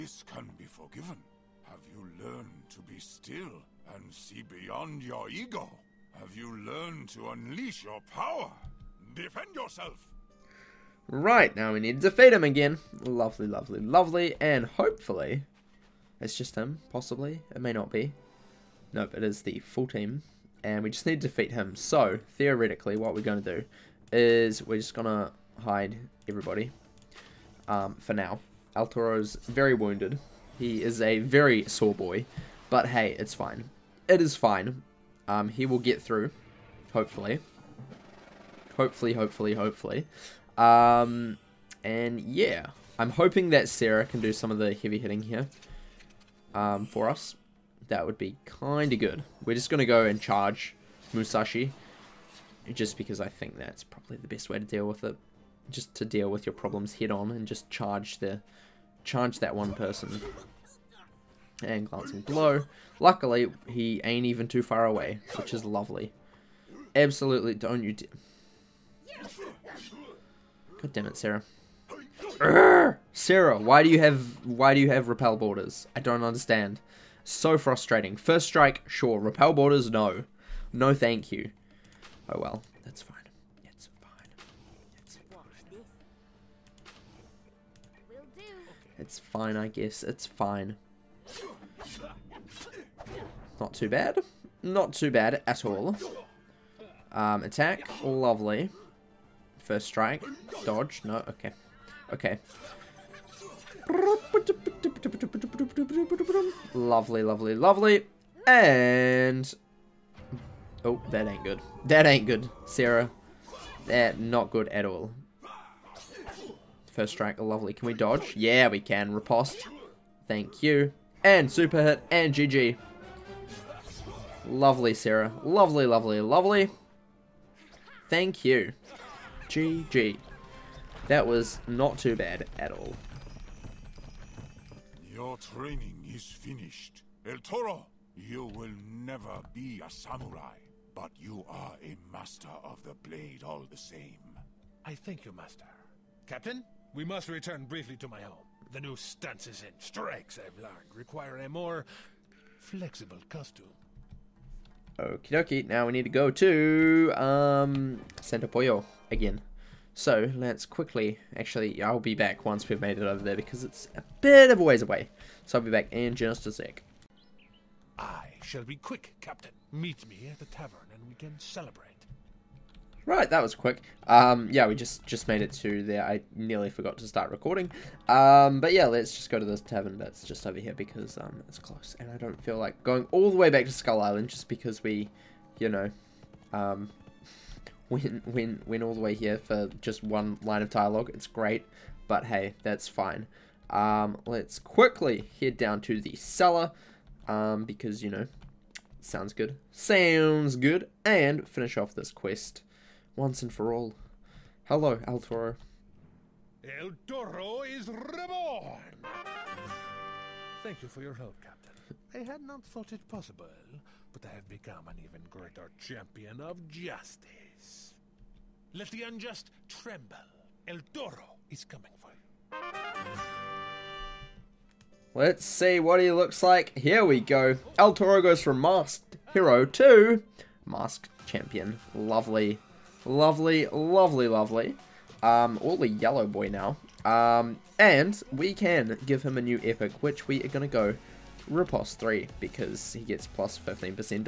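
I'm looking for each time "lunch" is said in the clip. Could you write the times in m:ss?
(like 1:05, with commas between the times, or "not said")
not said.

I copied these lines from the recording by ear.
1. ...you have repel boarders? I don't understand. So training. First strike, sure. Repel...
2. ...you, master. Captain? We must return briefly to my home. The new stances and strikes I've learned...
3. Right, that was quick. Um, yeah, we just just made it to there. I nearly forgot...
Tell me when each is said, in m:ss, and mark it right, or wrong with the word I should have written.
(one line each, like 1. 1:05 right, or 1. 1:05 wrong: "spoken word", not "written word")
1. 1:14 wrong: "frustrating", not "training"
2. 2:25 right
3. 2:53 right.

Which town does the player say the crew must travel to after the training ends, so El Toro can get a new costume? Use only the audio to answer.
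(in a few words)
Santa Pollo.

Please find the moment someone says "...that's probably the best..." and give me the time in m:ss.
0:53.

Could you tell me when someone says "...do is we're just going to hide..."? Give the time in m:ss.
0:23.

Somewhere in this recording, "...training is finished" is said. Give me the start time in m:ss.
2:15.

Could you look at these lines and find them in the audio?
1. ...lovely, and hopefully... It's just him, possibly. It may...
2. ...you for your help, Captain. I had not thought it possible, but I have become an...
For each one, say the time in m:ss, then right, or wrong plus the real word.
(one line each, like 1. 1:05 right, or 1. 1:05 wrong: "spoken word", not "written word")
1. 0:13 right
2. 3:30 right.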